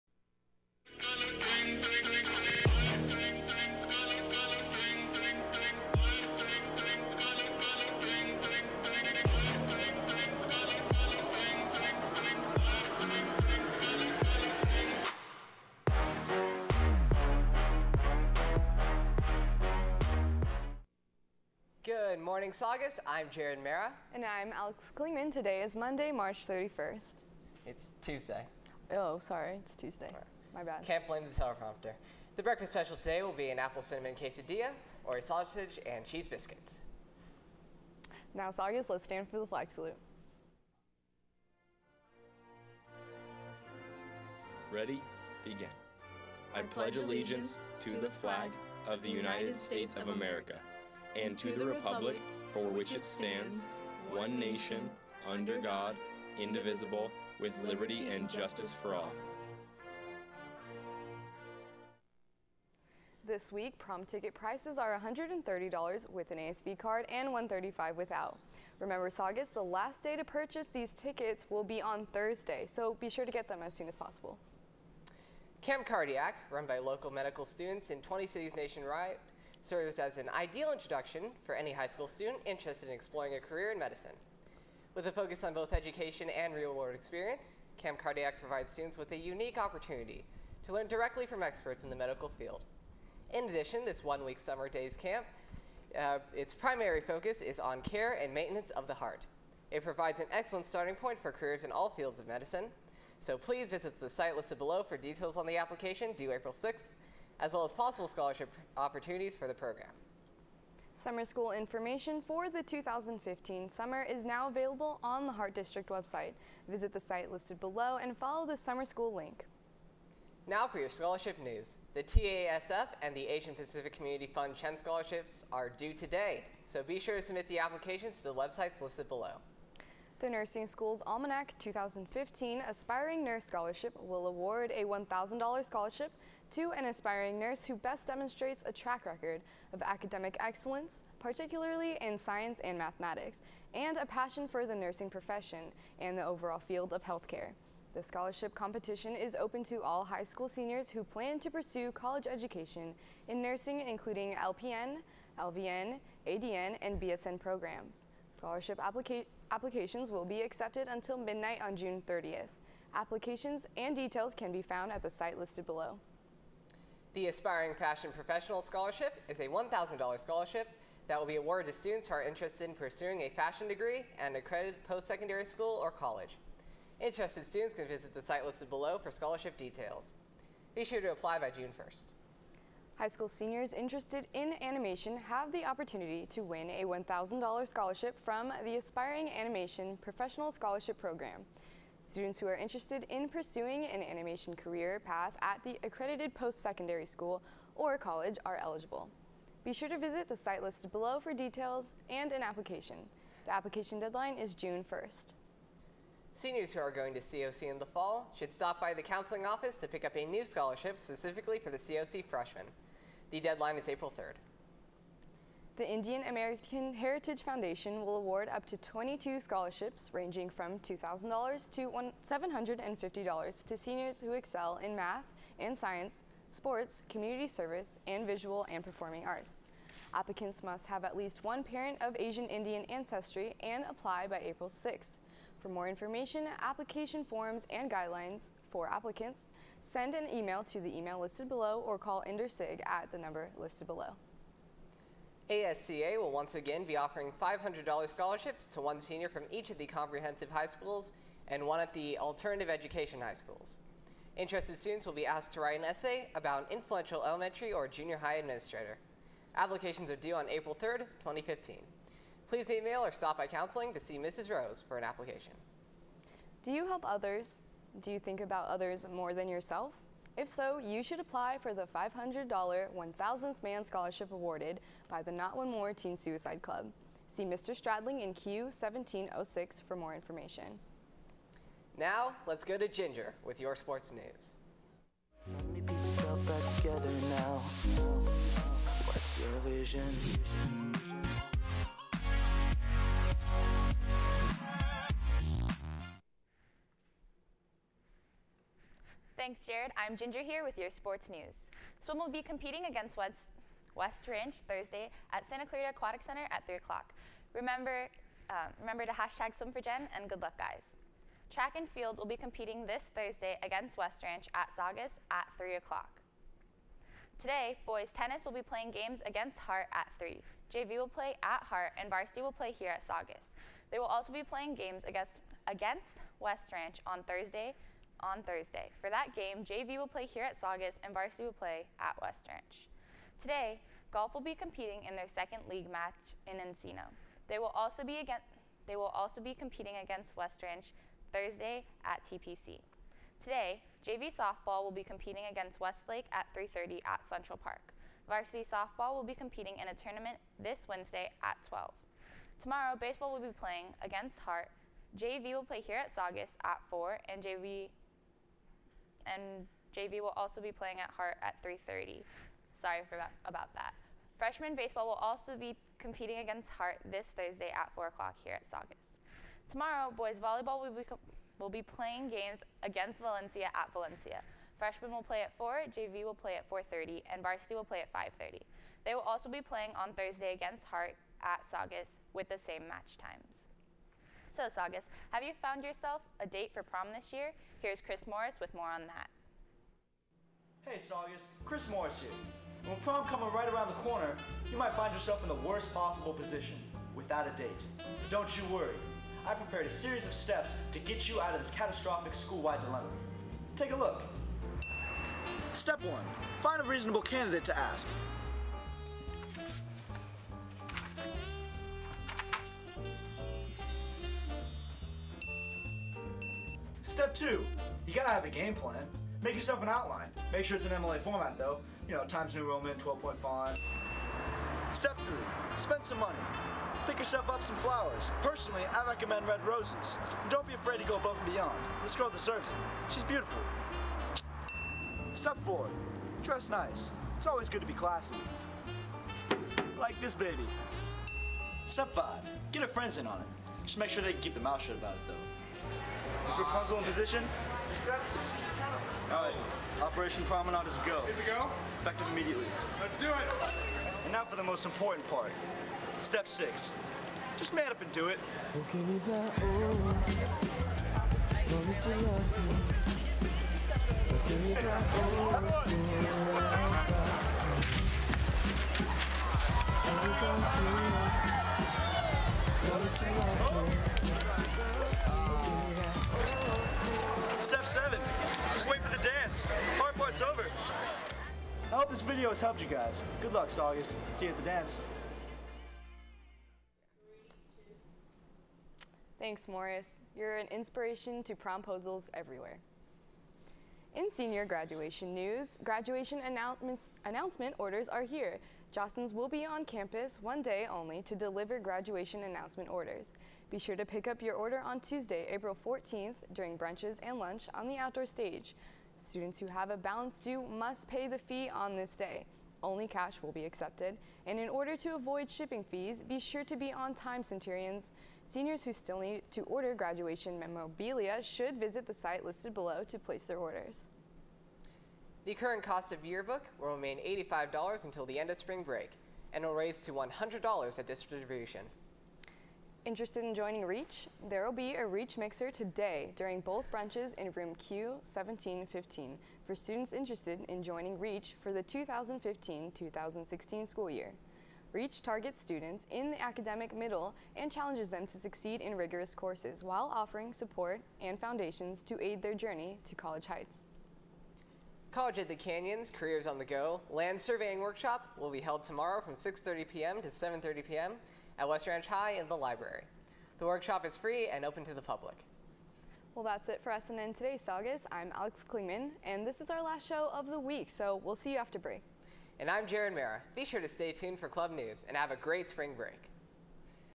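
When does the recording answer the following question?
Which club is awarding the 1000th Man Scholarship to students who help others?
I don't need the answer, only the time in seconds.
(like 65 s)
275 s.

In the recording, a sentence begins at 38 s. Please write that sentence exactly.
Now, Saugus, let's stand for the flag salute.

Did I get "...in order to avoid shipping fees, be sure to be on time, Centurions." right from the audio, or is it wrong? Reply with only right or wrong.
right.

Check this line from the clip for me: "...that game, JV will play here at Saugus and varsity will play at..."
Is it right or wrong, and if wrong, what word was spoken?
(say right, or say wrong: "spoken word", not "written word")
right.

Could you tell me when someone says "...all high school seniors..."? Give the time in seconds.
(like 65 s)
149 s.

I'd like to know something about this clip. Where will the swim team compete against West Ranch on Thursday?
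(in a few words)
Santa Clarita Aquatic Center.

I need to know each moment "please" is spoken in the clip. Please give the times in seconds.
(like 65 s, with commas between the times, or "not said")
103 s, 262 s.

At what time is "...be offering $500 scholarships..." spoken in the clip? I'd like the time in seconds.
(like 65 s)
246 s.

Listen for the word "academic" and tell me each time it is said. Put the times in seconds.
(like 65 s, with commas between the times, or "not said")
139 s, 546 s.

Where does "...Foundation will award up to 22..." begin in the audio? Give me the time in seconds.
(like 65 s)
217 s.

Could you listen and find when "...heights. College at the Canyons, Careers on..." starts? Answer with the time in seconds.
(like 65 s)
553 s.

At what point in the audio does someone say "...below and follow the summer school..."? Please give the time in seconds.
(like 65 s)
117 s.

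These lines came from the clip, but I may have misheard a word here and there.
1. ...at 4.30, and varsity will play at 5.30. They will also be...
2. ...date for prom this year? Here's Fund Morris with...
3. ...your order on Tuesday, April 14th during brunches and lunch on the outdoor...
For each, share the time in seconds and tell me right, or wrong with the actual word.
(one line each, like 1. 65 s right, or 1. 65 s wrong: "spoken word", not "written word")
1. 376 s right
2. 386 s wrong: "Chris", not "Fund"
3. 504 s right.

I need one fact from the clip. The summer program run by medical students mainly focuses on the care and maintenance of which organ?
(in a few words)
heart.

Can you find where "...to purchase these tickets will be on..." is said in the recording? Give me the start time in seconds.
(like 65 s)
70 s.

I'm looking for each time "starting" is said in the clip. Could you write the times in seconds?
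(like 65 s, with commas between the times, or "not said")
100 s.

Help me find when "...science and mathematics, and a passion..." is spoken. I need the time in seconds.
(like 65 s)
142 s.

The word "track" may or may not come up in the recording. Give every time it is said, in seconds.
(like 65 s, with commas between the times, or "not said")
138 s, 311 s.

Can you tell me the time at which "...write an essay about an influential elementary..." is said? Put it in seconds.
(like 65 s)
255 s.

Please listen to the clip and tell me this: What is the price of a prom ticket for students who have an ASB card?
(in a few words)
$130.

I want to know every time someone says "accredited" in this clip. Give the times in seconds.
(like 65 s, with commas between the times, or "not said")
174 s, 195 s.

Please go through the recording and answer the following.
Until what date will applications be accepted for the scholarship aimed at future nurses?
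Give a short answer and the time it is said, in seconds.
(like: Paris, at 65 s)
June 30th, at 161 s.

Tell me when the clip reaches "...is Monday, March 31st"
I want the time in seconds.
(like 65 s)
25 s.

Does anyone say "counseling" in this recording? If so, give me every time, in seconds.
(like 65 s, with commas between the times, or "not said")
209 s, 263 s.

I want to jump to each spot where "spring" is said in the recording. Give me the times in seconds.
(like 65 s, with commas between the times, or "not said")
528 s, 575 s.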